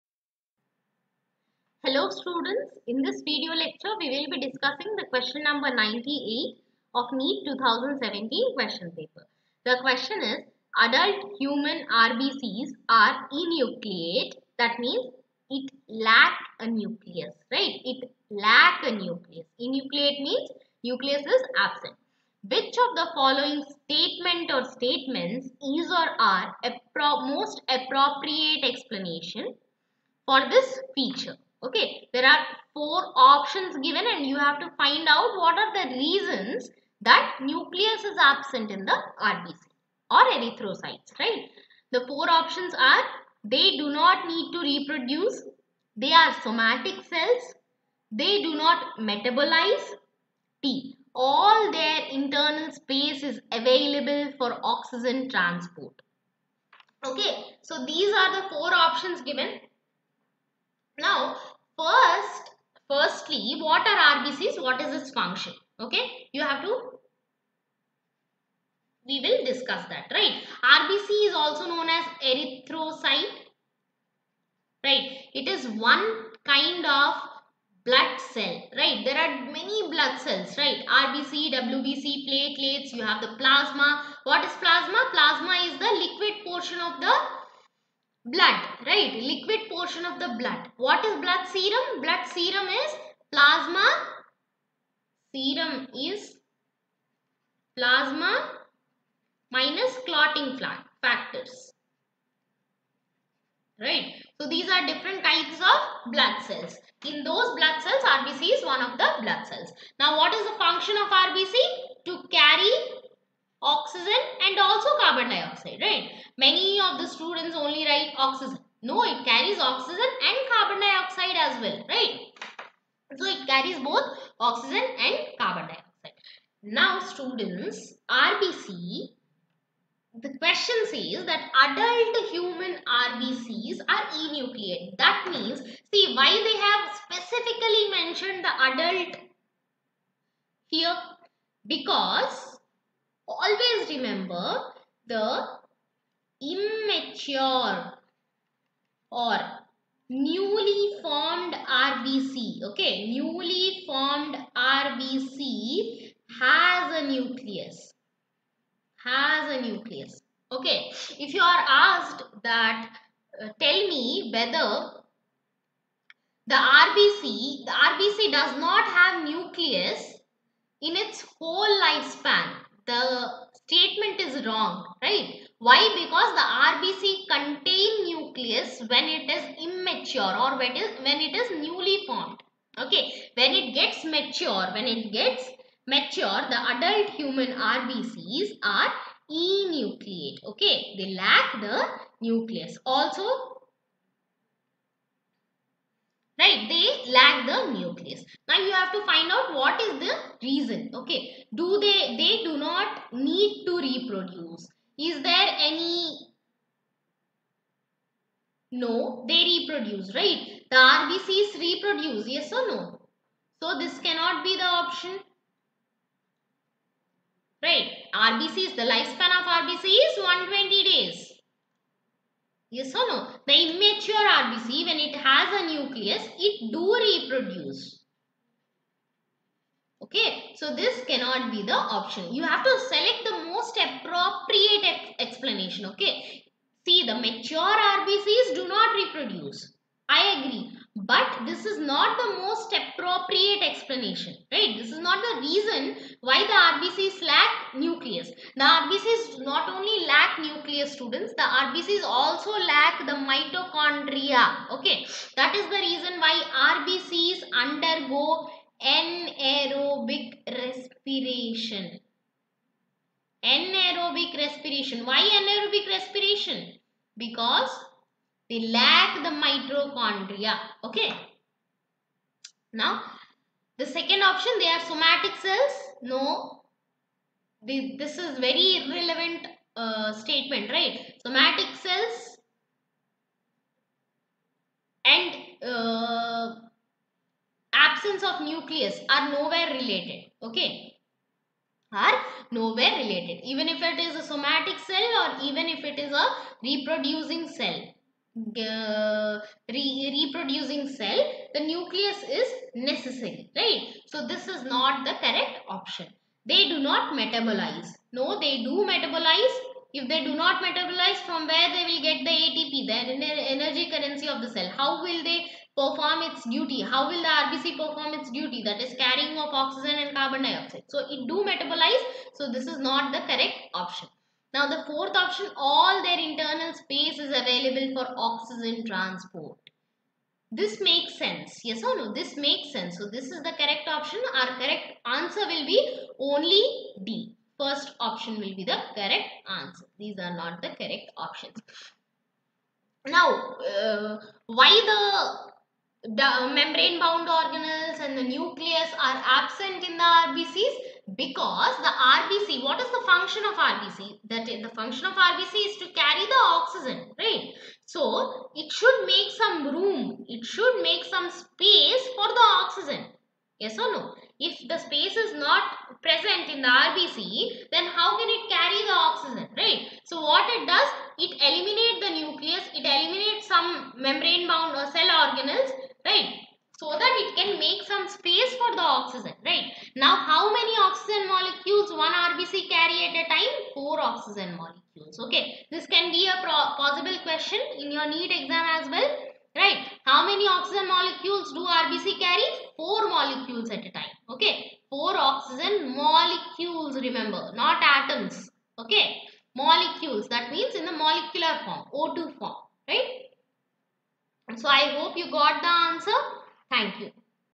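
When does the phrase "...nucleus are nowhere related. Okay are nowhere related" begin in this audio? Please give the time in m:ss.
4:48.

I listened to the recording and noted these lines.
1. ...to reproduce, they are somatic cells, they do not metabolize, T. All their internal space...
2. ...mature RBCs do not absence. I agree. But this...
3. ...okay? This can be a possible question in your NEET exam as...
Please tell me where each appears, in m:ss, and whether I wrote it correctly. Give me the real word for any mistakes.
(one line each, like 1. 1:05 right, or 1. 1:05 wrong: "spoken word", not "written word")
1. 0:44 right
2. 3:57 wrong: "reproduce", not "absence"
3. 6:25 right.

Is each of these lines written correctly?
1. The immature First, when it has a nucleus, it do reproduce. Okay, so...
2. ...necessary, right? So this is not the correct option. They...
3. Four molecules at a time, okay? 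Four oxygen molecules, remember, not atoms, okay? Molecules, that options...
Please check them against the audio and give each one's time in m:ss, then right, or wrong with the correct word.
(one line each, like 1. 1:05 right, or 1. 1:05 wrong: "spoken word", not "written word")
1. 3:43 wrong: "RBC", not "First"
2. 5:02 right
3. 6:32 wrong: "means", not "options".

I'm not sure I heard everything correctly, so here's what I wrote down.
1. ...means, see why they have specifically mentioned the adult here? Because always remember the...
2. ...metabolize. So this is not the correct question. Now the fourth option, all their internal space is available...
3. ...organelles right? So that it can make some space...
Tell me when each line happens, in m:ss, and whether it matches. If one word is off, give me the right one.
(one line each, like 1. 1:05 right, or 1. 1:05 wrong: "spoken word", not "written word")
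1. 2:15 right
2. 5:21 wrong: "option", not "question"
3. 6:15 right.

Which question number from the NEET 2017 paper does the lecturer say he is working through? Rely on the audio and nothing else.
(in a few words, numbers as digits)
98.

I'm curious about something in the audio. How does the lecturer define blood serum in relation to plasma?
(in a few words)
Plasma minus clotting factors.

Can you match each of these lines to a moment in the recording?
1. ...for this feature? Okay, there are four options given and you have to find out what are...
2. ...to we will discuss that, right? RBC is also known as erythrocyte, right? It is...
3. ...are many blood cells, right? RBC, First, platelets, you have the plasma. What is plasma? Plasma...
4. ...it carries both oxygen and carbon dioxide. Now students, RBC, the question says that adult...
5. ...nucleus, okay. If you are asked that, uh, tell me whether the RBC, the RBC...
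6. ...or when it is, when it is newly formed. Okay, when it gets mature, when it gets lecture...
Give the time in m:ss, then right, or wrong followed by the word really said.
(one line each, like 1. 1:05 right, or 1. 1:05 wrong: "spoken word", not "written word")
1. 0:30 right
2. 1:06 right
3. 1:19 wrong: "WBC", not "First"
4. 2:03 right
5. 2:39 right
6. 3:00 wrong: "mature", not "lecture".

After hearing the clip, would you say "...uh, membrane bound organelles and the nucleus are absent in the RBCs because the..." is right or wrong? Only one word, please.
right.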